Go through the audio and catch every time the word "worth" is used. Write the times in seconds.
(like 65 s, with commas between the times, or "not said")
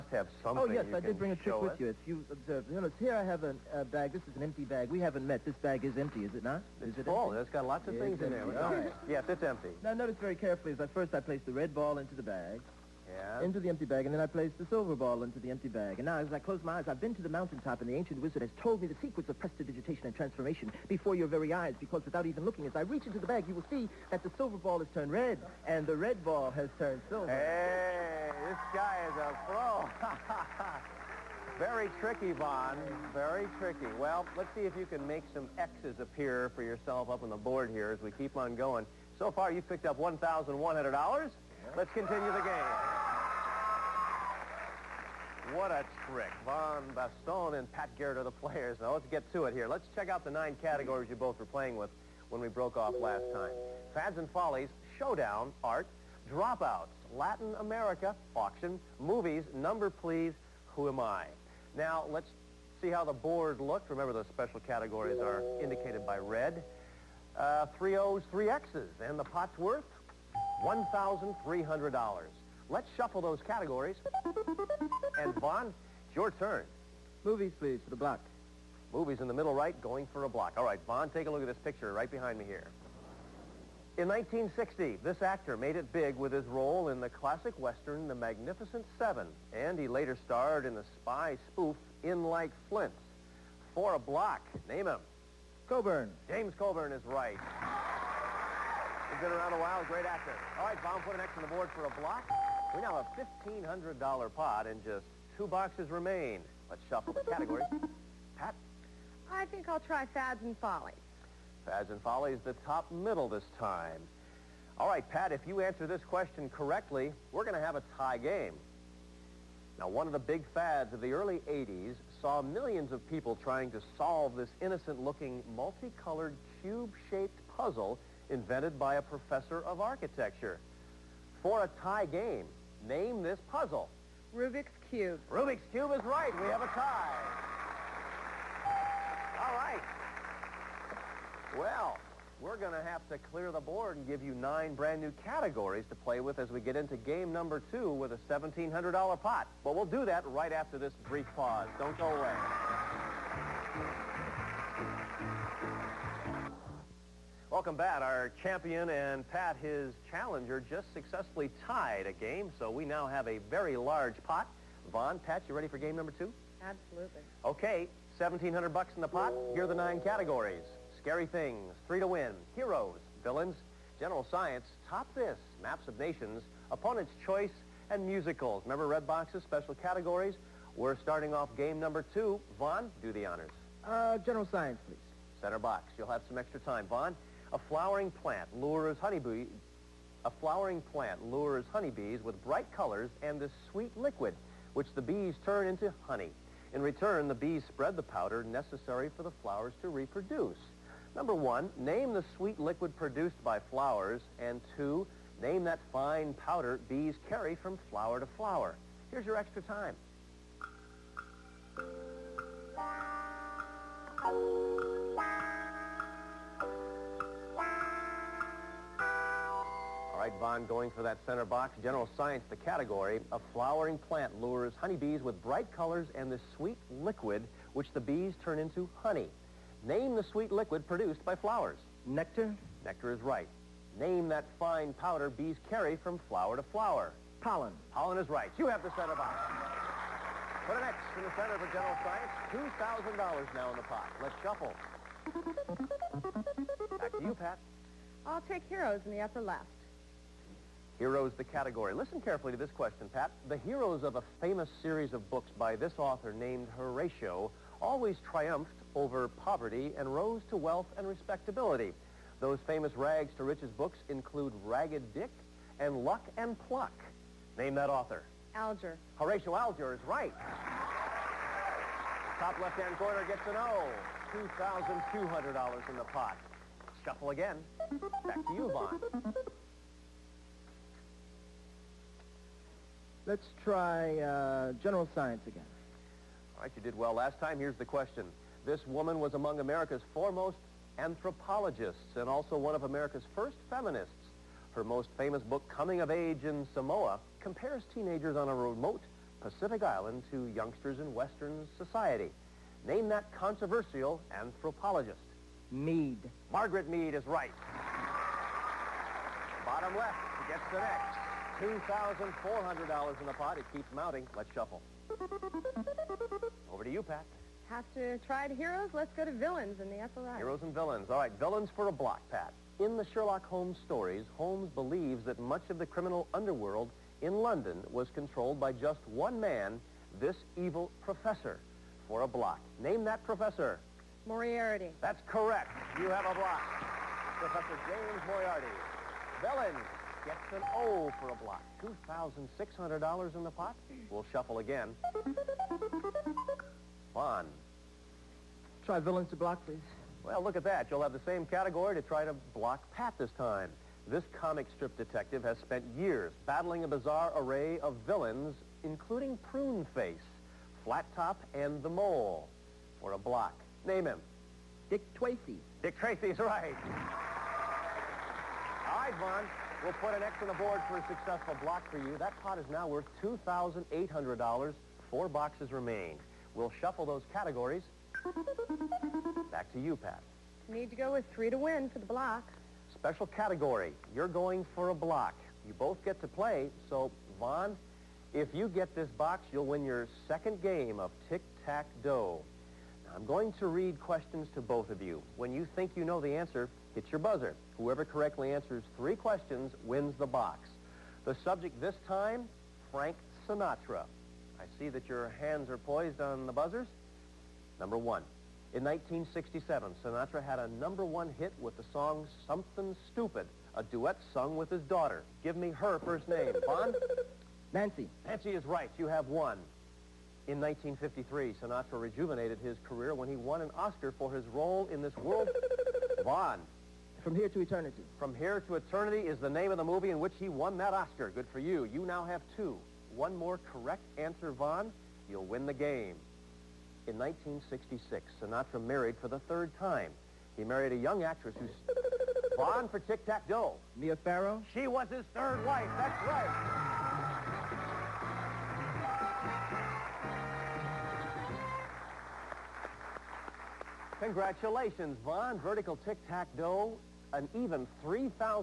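69 s, 372 s.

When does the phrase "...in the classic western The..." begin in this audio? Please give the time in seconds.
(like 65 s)
86 s.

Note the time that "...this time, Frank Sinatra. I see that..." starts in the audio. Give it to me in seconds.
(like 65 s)
401 s.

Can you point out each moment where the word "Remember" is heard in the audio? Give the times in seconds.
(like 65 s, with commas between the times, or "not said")
63 s, 178 s.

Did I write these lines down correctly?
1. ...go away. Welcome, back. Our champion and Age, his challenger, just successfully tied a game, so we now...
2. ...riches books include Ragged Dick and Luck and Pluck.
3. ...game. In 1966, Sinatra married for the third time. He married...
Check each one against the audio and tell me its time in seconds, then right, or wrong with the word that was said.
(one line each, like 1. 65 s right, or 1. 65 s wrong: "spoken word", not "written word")
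1. 151 s wrong: "Pat", not "Age"
2. 263 s right
3. 435 s right.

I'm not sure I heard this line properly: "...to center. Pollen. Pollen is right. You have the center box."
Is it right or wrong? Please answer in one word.
wrong.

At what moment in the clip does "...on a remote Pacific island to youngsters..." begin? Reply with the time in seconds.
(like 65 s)
298 s.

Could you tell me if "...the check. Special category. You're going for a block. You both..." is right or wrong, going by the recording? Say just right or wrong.
wrong.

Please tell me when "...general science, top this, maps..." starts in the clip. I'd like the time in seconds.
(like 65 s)
173 s.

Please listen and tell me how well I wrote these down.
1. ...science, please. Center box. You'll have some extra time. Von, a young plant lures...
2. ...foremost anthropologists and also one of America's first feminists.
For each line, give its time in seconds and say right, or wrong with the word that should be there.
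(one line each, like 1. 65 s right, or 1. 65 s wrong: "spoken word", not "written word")
1. 184 s wrong: "flowering", not "young"
2. 290 s right.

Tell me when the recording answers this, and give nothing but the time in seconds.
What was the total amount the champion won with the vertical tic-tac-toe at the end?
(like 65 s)
458 s.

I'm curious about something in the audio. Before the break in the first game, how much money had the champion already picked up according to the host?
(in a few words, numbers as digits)
$1,100.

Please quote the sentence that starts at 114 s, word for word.
All right, Pat, if you answer this question correctly, we're going to have a tie game.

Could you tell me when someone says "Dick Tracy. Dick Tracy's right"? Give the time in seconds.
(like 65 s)
364 s.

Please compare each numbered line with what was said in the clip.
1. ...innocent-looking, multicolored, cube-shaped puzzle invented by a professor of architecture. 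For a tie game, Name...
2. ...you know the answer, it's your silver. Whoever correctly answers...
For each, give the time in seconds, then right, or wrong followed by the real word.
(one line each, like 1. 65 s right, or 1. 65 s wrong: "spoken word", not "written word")
1. 124 s right
2. 395 s wrong: "buzzer", not "silver".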